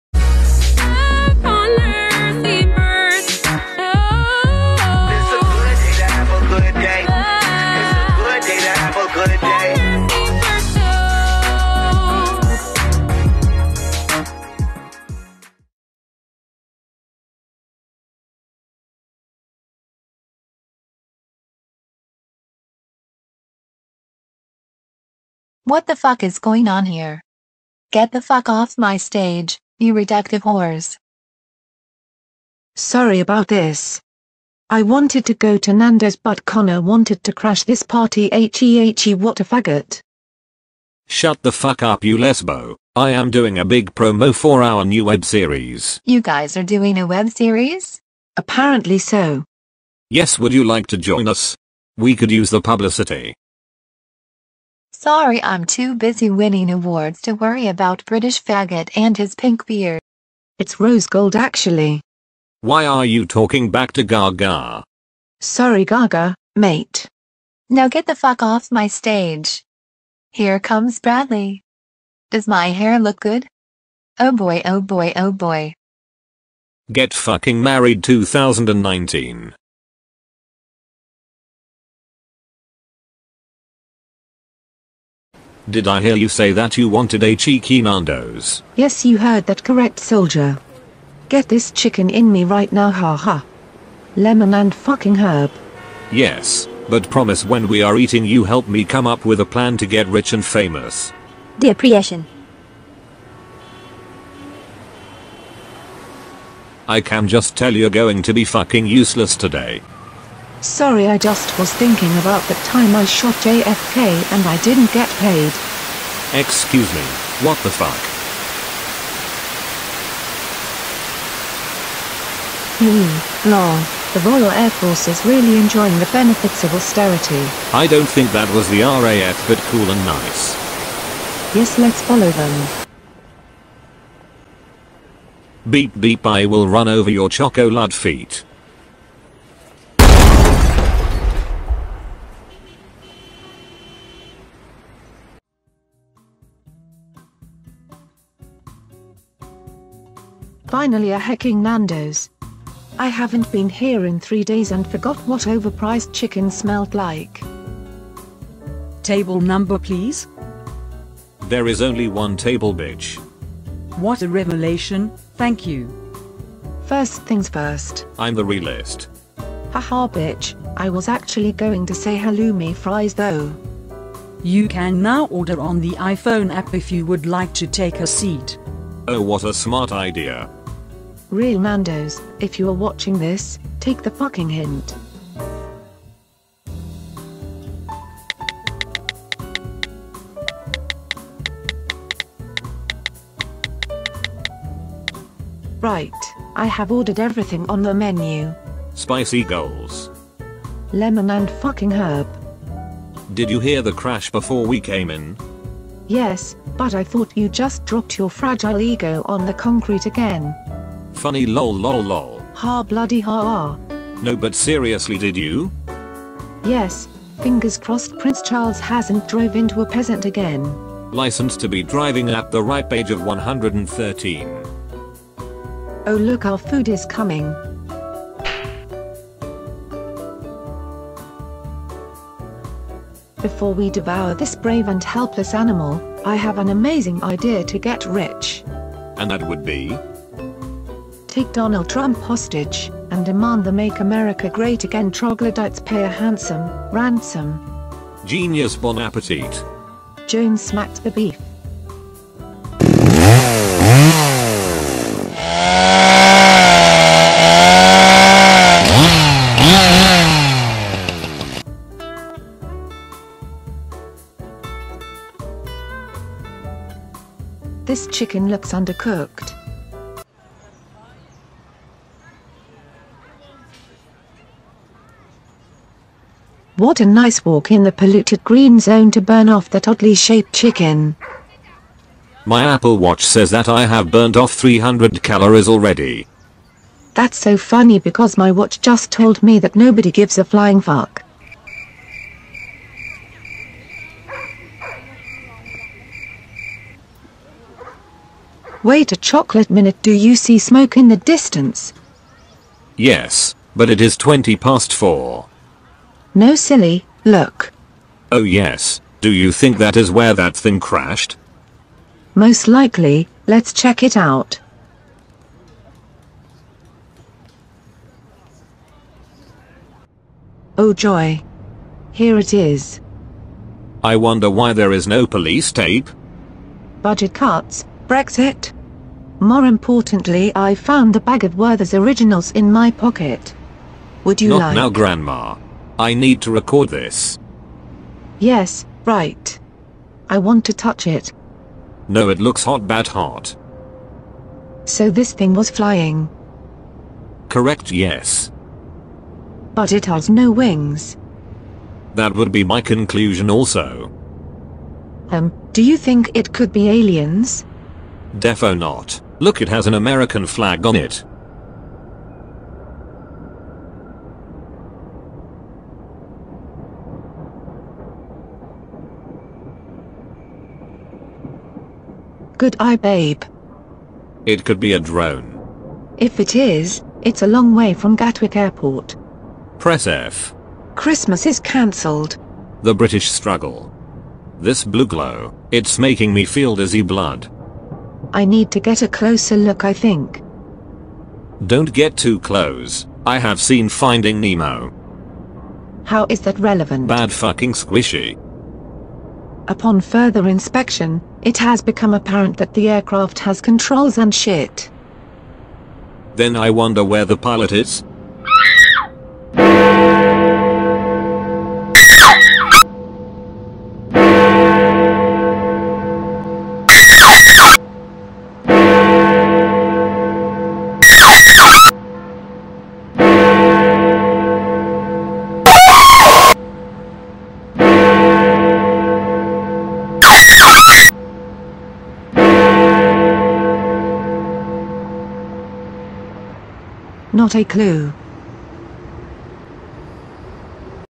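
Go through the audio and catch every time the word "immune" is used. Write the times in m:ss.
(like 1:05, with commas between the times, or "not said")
not said.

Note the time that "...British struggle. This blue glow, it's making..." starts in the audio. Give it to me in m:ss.
6:22.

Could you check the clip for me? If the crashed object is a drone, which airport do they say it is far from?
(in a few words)
Gatwick Airport.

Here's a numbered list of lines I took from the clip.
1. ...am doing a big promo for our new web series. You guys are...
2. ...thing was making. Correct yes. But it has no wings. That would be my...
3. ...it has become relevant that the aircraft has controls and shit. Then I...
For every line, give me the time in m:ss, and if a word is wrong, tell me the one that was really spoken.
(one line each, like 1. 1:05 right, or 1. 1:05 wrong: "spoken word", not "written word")
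1. 0:43 right
2. 5:45 wrong: "flying", not "making"
3. 6:41 wrong: "apparent", not "relevant".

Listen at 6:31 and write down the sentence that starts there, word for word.
Don't get too close, I have seen Finding Nemo.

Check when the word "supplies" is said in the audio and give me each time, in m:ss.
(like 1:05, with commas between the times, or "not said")
not said.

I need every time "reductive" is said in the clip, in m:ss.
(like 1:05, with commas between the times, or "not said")
0:29.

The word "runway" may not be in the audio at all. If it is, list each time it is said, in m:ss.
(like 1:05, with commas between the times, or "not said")
not said.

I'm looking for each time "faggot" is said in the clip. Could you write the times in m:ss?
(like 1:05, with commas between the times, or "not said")
0:39, 0:58.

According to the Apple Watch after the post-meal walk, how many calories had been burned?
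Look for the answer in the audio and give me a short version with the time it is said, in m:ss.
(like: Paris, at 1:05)
300, at 4:44.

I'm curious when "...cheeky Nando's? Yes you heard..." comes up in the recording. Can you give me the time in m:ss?
1:27.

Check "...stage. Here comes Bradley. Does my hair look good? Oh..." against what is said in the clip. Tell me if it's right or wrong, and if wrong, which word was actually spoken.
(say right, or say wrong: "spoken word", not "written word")
right.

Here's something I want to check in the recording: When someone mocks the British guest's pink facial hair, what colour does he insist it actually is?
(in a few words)
Rose gold.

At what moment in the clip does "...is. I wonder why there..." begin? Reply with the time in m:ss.
5:22.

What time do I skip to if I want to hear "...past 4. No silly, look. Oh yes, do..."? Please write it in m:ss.
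5:04.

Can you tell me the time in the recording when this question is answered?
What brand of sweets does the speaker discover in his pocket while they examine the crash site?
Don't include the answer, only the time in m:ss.
5:31.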